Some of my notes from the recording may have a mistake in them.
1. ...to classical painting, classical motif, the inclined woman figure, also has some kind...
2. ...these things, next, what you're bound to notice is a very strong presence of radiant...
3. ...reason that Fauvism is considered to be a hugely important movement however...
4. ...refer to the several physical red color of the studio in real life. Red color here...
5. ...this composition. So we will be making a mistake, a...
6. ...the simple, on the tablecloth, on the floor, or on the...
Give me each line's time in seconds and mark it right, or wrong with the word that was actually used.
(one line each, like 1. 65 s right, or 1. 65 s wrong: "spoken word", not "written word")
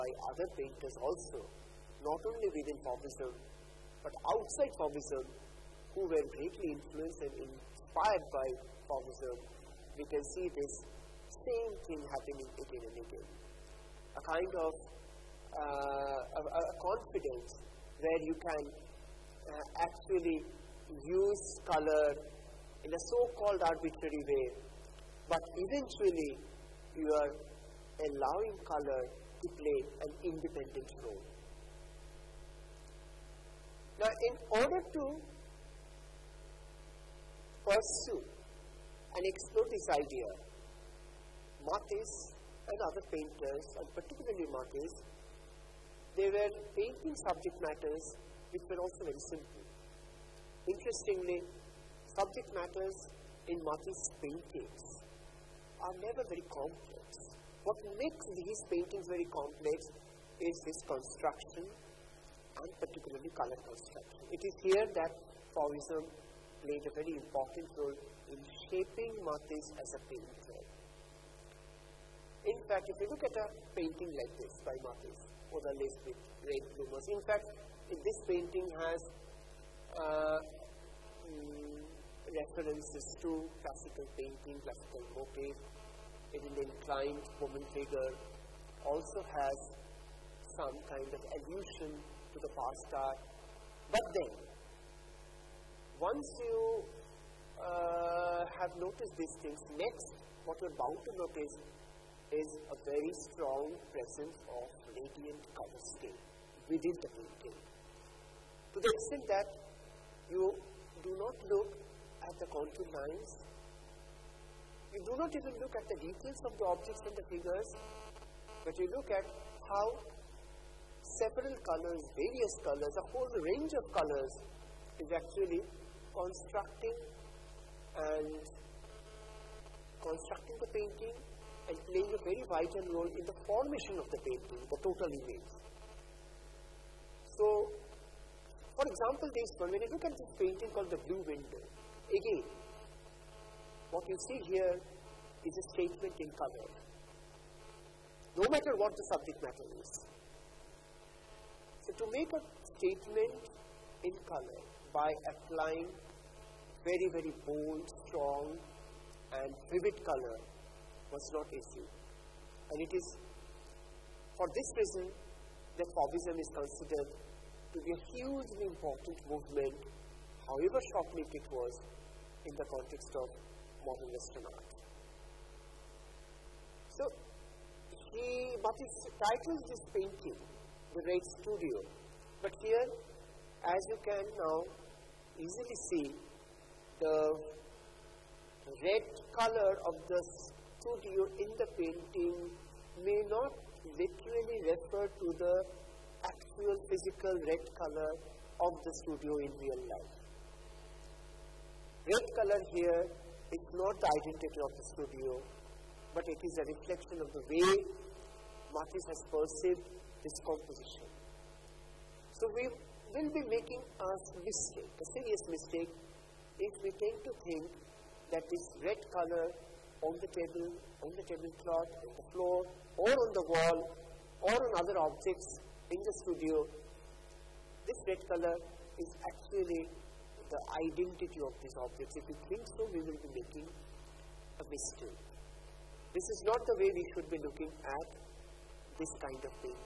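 1. 83 s right
2. 99 s right
3. 164 s right
4. 194 s wrong: "actual", not "several"
5. 210 s right
6. 220 s wrong: "table", not "simple".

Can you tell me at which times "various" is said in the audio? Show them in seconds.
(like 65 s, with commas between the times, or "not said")
122 s.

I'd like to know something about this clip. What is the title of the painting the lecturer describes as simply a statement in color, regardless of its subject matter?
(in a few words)
The Blue Window.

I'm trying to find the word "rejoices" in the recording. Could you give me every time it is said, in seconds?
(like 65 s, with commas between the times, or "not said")
not said.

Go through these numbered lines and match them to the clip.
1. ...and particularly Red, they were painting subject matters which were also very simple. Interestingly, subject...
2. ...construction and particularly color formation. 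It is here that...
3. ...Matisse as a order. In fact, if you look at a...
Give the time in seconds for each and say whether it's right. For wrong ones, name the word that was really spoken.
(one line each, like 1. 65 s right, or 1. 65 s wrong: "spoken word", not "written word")
1. 43 s wrong: "Matisse", not "Red"
2. 60 s wrong: "construction", not "formation"
3. 69 s wrong: "painter", not "order".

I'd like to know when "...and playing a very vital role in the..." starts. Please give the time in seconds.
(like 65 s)
131 s.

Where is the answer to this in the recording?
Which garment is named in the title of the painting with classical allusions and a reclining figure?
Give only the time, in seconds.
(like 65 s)
76 s.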